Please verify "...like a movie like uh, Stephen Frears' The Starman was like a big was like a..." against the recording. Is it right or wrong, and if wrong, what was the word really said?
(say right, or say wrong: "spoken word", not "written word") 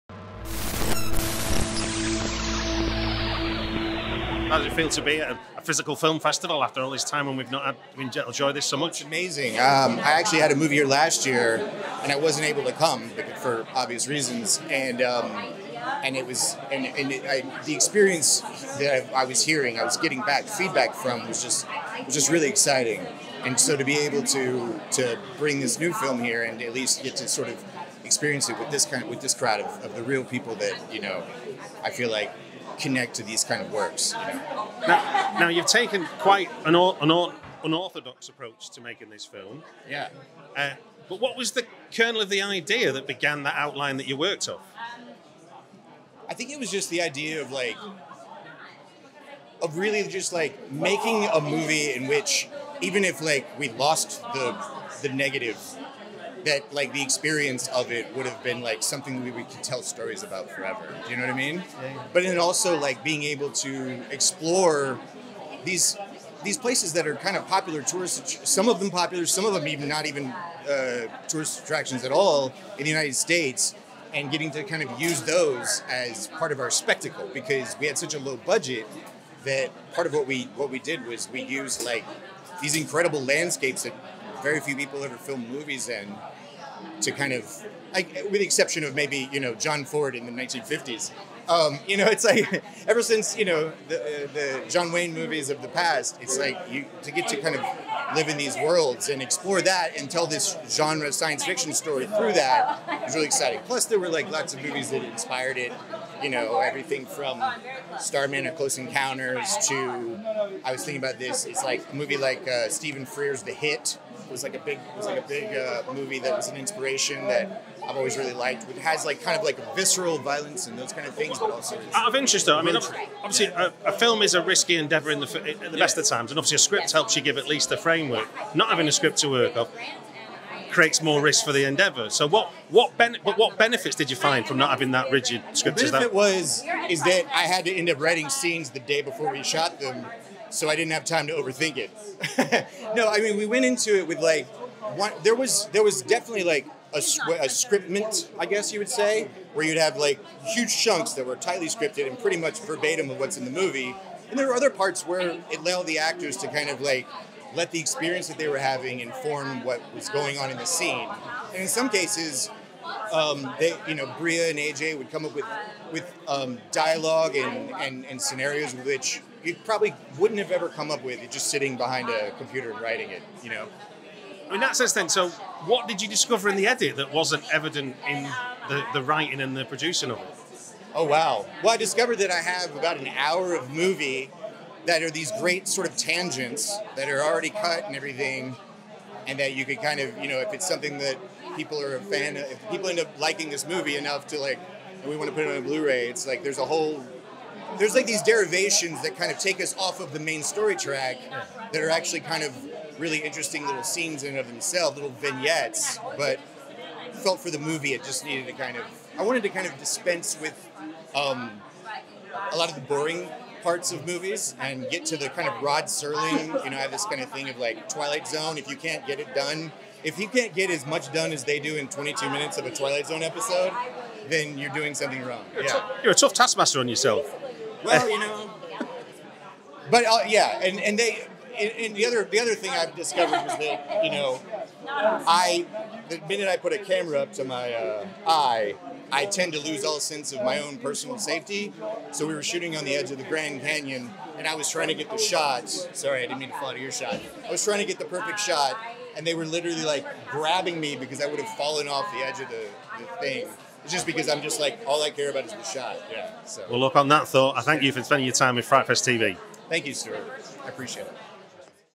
wrong: "Hit", not "Starman".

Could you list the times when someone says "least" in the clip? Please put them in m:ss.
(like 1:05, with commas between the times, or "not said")
0:26, 2:07.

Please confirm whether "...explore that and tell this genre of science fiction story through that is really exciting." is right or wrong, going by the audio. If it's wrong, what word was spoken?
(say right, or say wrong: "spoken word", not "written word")
right.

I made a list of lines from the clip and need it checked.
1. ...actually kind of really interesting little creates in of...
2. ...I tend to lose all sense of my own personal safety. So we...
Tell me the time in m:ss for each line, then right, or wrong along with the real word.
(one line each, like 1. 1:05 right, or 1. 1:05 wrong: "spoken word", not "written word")
1. 3:21 wrong: "scenes", not "creates"
2. 3:59 right.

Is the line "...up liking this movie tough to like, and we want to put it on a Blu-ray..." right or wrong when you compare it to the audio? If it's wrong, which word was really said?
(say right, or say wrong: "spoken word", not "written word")
wrong: "enough", not "tough".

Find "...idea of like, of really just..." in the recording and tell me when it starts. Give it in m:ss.
0:47.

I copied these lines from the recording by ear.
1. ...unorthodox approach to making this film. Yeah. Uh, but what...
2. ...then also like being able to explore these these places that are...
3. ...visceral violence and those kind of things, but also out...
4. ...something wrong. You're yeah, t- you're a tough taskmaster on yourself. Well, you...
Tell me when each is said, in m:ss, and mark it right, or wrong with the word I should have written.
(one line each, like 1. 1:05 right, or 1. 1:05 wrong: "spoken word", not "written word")
1. 0:37 right
2. 1:02 right
3. 1:59 right
4. 3:44 right.